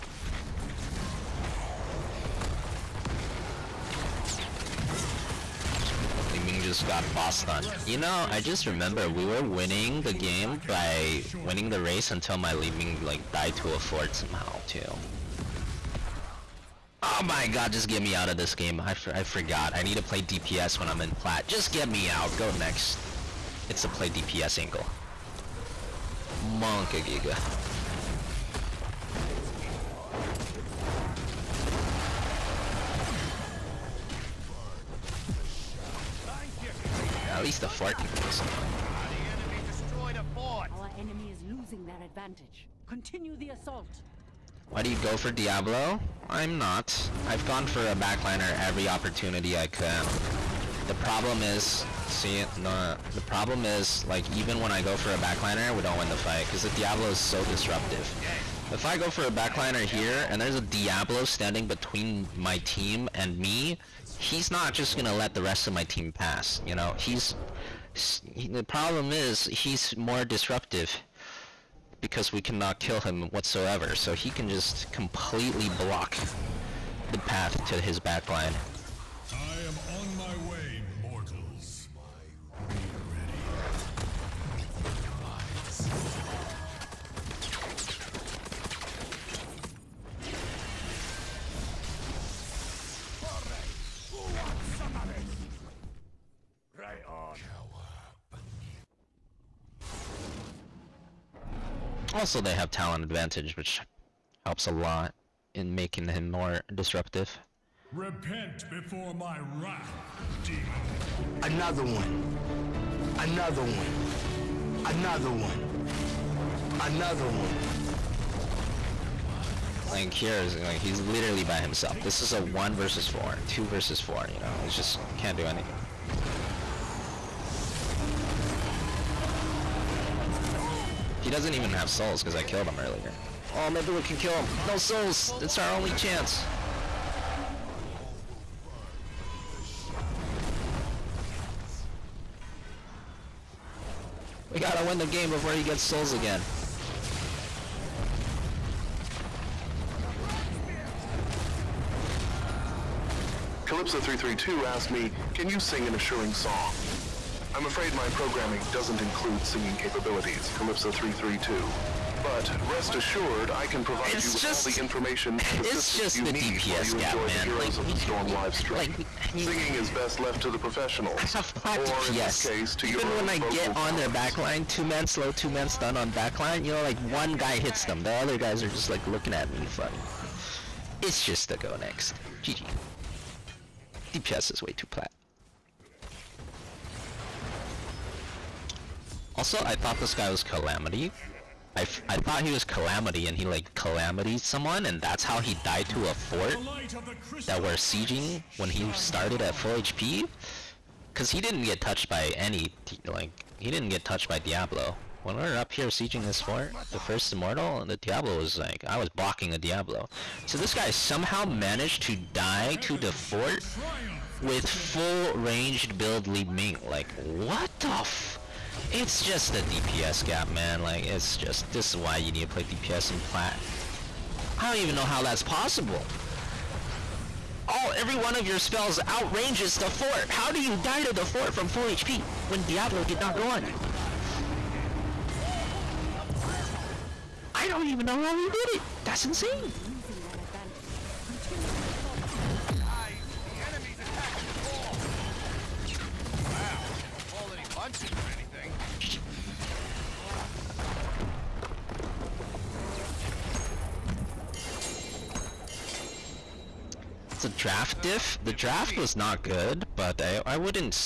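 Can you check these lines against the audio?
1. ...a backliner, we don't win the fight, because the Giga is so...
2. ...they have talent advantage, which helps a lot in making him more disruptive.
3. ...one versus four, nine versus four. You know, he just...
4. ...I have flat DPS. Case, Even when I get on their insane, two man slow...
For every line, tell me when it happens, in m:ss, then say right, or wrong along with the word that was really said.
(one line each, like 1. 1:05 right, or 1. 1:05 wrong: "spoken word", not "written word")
1. 0:55 wrong: "Diablo", not "Giga"
2. 1:42 right
3. 2:02 wrong: "two", not "nine"
4. 2:51 wrong: "backline", not "insane".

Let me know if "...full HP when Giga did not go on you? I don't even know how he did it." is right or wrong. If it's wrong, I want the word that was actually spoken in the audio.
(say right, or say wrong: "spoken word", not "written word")
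wrong: "Diablo", not "Giga".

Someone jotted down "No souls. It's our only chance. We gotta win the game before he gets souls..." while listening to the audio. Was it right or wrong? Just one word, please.
right.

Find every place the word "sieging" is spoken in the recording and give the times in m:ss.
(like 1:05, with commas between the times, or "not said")
3:17, 3:25.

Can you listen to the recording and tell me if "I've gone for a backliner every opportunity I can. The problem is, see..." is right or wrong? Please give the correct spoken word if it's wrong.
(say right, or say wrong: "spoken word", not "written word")
right.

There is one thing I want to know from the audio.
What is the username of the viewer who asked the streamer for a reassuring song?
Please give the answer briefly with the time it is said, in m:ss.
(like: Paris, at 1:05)
Calypso332, at 2:33.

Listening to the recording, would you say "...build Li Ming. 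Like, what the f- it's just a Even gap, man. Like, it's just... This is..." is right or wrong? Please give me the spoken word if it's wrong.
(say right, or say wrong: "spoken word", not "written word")
wrong: "DPS", not "Even".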